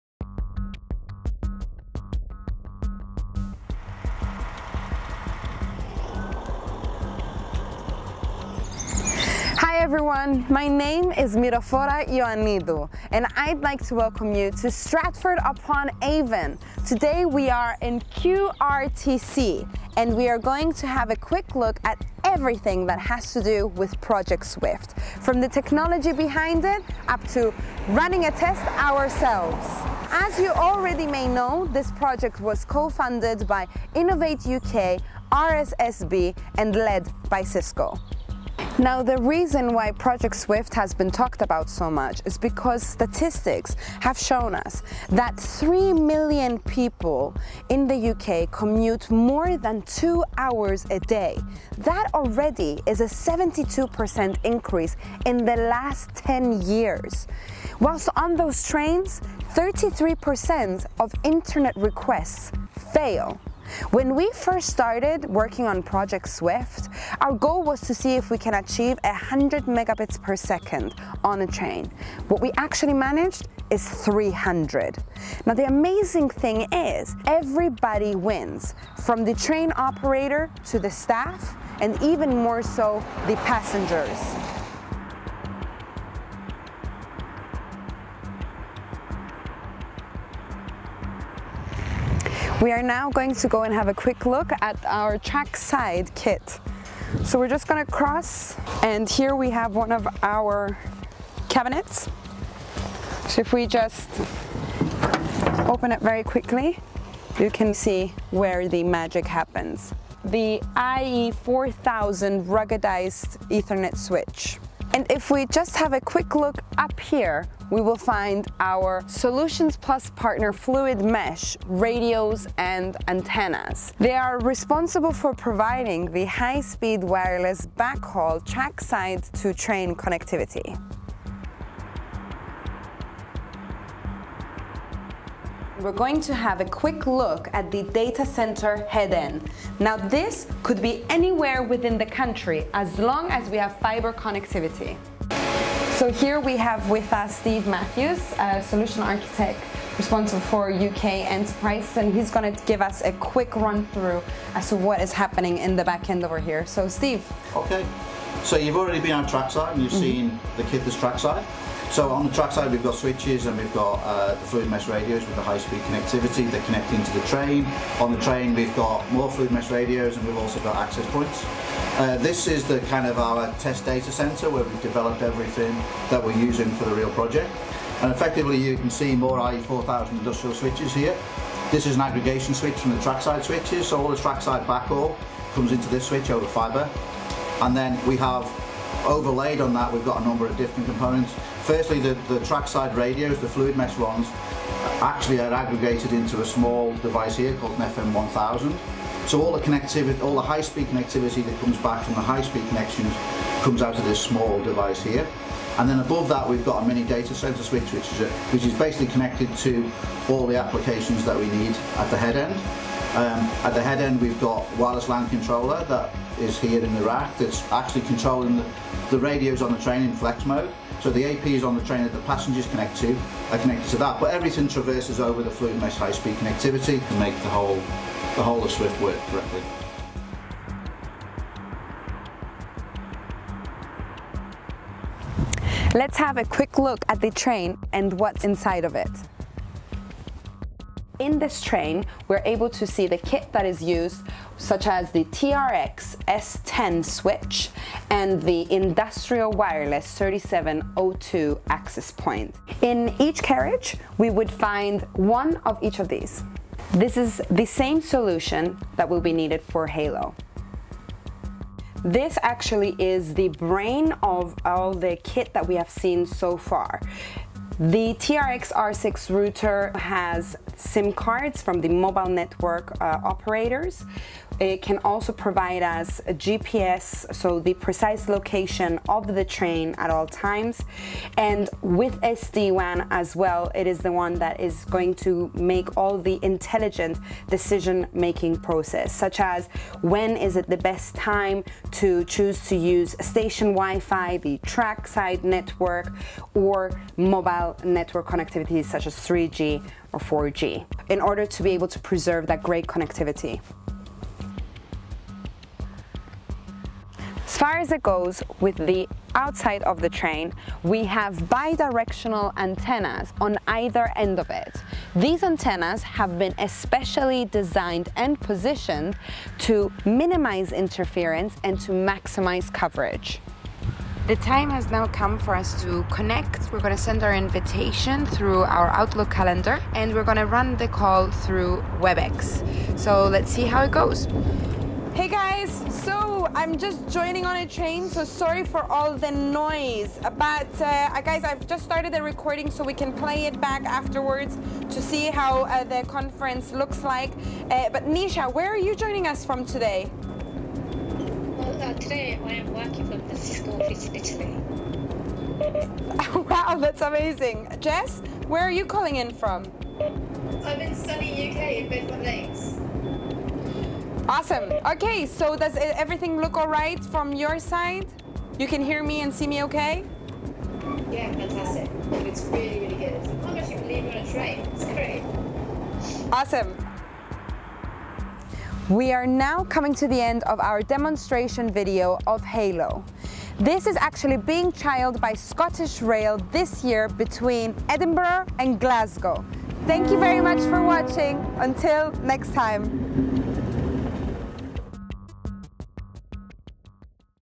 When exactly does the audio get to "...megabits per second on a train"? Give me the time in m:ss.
1:09.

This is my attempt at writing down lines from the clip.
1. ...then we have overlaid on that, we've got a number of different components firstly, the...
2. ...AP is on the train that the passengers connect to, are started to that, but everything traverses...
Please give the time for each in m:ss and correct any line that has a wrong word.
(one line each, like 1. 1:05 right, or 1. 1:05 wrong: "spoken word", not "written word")
1. 3:07 right
2. 3:41 wrong: "connected", not "started".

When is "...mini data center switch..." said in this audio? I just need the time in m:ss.
3:26.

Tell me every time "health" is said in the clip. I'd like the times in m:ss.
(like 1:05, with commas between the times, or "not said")
not said.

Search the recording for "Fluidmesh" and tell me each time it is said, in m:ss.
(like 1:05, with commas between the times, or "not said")
2:00, 2:44, 2:49, 3:13, 3:45.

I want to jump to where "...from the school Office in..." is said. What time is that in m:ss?
5:53.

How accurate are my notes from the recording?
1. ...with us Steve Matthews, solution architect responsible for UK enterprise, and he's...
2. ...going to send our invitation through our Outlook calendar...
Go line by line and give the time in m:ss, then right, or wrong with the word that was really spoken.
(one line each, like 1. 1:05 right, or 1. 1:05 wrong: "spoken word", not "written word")
1. 2:26 right
2. 5:26 right.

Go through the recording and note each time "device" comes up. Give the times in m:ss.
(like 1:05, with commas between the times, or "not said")
3:16, 3:24.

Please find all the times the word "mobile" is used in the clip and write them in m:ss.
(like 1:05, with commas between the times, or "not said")
4:31, 4:57.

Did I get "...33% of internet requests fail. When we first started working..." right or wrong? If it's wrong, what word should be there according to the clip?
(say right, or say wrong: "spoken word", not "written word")
right.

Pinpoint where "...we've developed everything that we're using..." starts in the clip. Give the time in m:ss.
2:54.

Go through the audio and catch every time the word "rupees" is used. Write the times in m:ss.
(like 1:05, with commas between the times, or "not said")
not said.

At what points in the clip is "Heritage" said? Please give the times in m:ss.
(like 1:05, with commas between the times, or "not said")
not said.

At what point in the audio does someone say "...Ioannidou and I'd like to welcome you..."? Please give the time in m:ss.
0:12.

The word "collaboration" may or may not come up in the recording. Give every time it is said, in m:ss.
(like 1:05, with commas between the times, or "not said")
not said.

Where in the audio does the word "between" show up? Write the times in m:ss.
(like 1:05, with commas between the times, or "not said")
6:27.